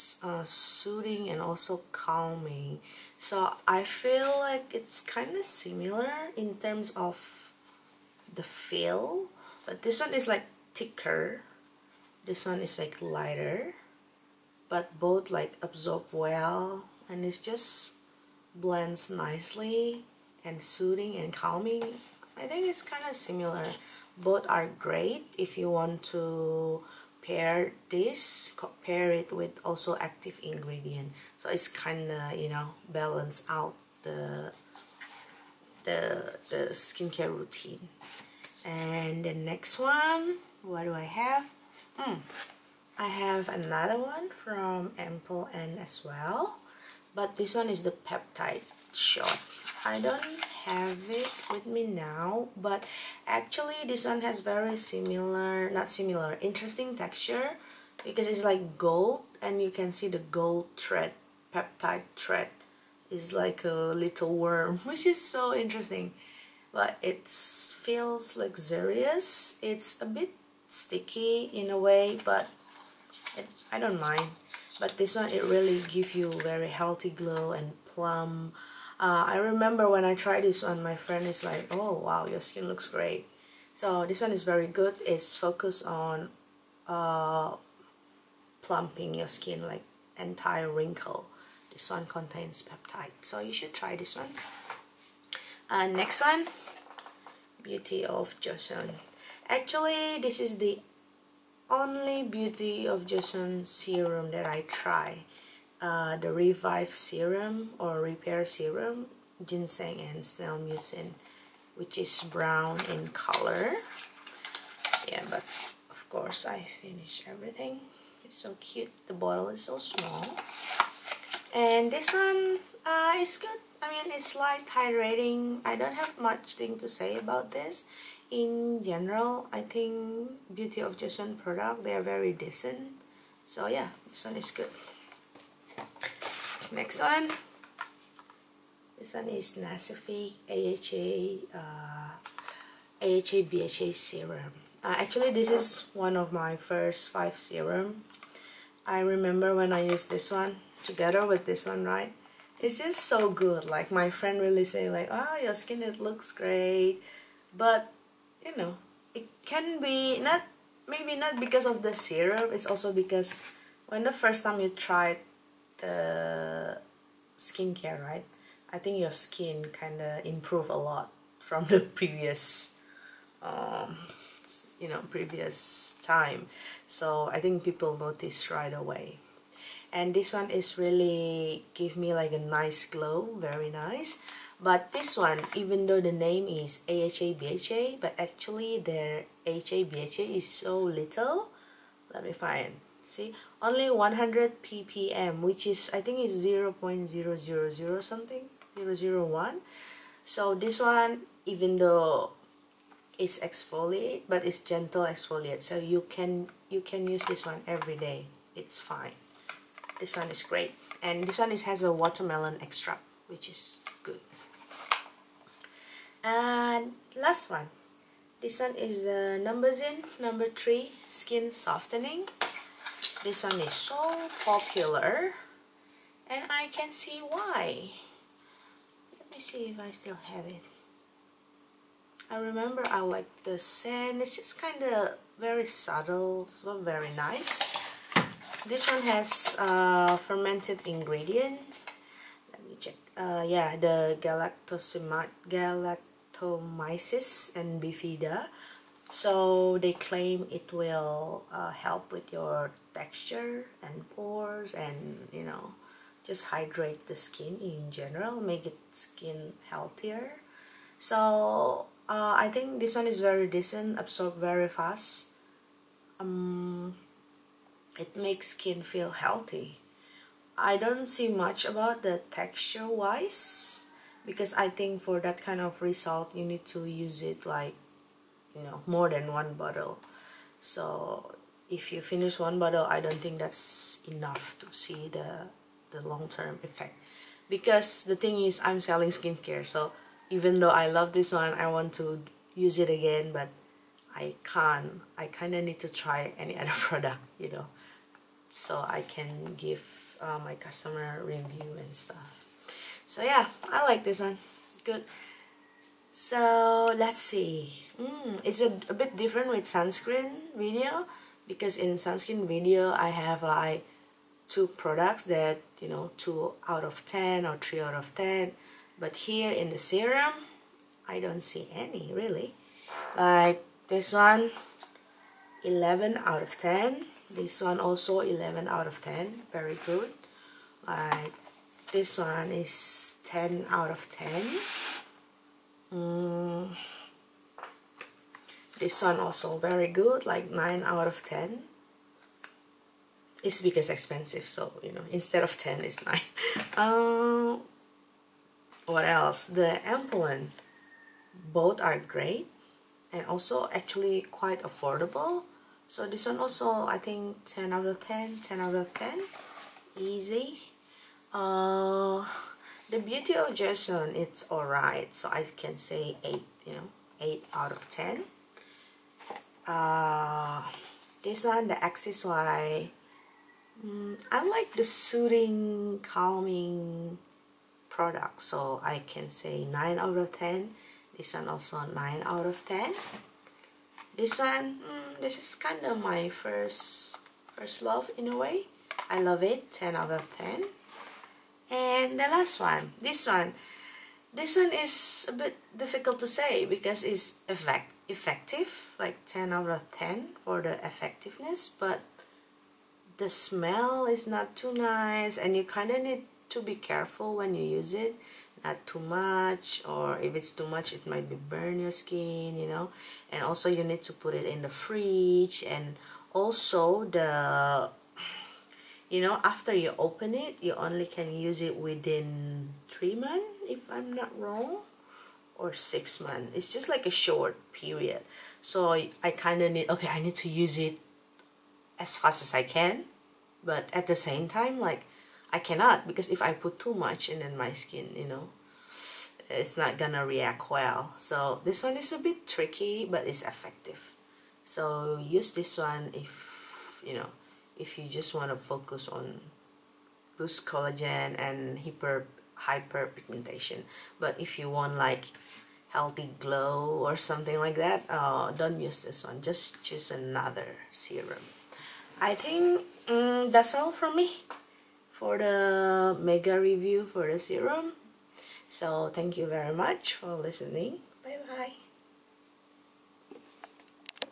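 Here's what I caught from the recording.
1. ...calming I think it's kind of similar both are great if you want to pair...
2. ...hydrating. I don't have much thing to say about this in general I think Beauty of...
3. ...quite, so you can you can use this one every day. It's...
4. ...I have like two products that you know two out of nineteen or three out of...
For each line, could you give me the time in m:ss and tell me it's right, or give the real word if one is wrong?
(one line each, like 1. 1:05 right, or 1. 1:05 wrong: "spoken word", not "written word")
1. 0:21 right
2. 2:04 right
3. 3:25 wrong: "exfoliate", not "quite"
4. 5:12 wrong: "ten", not "nineteen".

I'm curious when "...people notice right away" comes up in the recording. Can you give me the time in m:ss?
2:57.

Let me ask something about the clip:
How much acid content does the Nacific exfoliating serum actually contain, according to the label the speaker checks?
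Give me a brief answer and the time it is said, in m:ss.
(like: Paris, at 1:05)
100 ppm, at 3:13.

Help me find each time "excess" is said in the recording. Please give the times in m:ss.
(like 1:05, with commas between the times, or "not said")
not said.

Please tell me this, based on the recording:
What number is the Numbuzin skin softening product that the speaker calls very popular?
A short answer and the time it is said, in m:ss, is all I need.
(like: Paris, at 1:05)
3, at 3:40.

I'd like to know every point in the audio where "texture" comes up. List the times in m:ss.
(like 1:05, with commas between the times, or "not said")
0:56, 4:12, 4:32.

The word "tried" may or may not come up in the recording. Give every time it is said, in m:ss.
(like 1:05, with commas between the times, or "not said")
1:20, 2:44.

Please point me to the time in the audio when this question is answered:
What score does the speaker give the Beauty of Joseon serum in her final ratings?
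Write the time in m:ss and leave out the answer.
6:07.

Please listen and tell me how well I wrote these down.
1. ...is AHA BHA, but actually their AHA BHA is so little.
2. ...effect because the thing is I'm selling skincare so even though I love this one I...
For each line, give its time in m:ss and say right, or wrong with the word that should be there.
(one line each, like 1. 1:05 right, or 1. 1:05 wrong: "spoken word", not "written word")
1. 3:06 right
2. 4:46 right.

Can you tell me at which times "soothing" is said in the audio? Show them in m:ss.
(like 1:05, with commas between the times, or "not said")
0:00, 0:20, 6:14.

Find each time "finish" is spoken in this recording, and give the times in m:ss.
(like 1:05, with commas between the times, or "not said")
1:56, 4:42.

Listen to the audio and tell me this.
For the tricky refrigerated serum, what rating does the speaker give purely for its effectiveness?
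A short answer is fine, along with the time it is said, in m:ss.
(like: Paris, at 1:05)
10 out of 10, at 6:39.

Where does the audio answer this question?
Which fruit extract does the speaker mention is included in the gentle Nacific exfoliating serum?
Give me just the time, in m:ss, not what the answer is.
3:31.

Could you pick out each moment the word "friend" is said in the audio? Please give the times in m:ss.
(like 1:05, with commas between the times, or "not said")
1:20, 2:34.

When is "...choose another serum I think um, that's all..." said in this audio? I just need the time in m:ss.
7:39.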